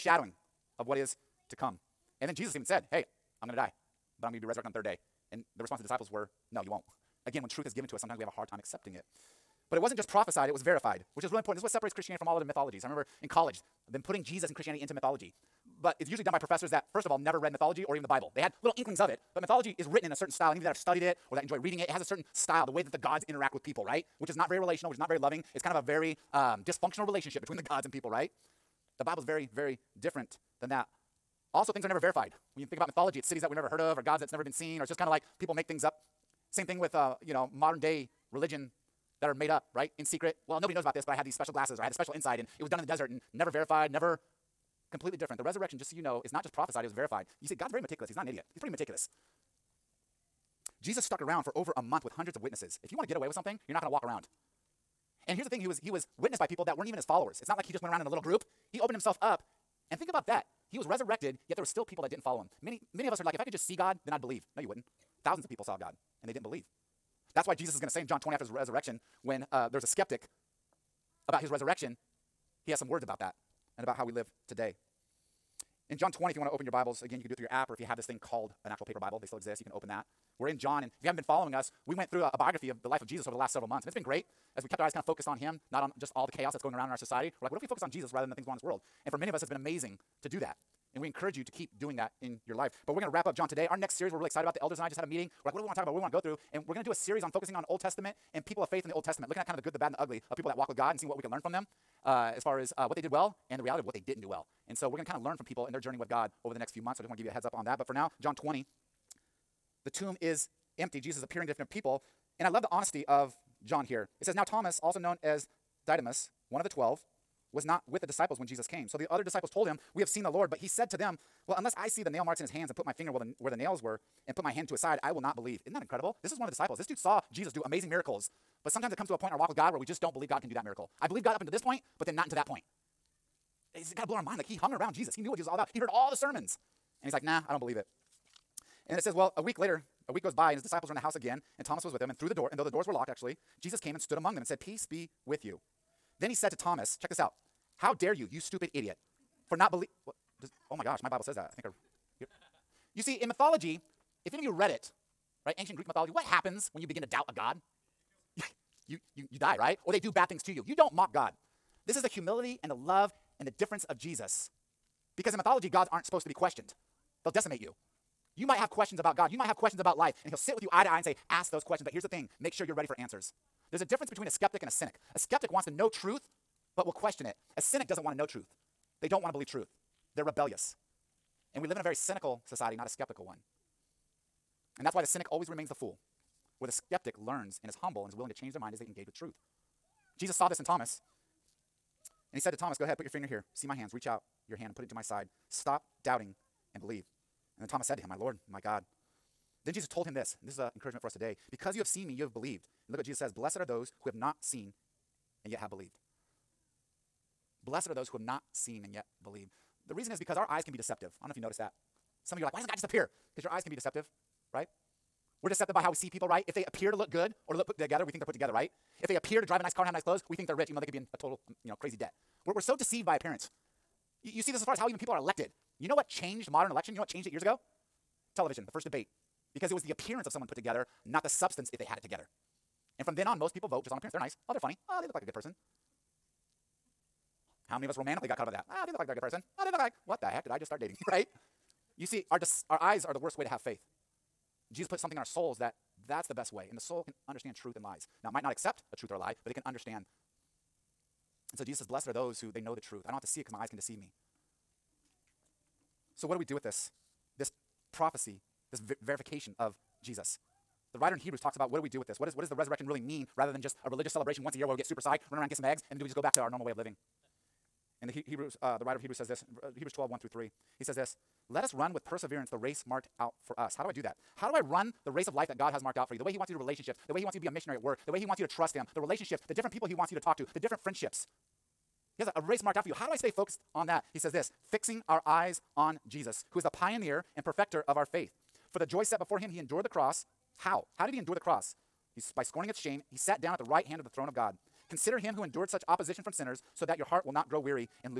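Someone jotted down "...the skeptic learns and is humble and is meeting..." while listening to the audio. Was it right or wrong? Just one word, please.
wrong.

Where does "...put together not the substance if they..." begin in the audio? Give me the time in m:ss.
3:50.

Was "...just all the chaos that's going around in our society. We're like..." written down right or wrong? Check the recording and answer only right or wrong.
right.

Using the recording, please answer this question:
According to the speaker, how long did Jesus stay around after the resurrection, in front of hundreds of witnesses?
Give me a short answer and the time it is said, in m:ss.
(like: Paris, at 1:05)
over a month, at 0:51.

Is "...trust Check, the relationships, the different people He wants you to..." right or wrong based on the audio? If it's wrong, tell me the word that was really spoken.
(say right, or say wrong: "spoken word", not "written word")
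wrong: "Him", not "Check".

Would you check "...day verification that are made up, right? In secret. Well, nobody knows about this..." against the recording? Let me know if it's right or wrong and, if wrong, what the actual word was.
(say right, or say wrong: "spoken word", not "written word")
wrong: "religion", not "verification".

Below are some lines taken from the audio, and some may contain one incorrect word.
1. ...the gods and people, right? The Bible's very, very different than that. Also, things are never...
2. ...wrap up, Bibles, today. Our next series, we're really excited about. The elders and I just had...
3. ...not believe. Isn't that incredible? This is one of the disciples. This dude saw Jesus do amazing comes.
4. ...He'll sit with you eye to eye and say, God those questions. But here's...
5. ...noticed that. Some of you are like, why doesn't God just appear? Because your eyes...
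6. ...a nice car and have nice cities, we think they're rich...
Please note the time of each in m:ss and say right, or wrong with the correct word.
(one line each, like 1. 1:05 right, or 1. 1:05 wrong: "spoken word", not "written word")
1. 0:27 right
2. 1:33 wrong: "John", not "Bibles"
3. 2:05 wrong: "miracles", not "comes"
4. 2:50 wrong: "Ask", not "God"
5. 3:31 right
6. 3:39 wrong: "clothes", not "cities".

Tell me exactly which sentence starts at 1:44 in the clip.
And so we're going to kind of learn from people and their journey with God over the next few months.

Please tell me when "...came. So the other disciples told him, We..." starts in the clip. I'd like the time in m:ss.
1:58.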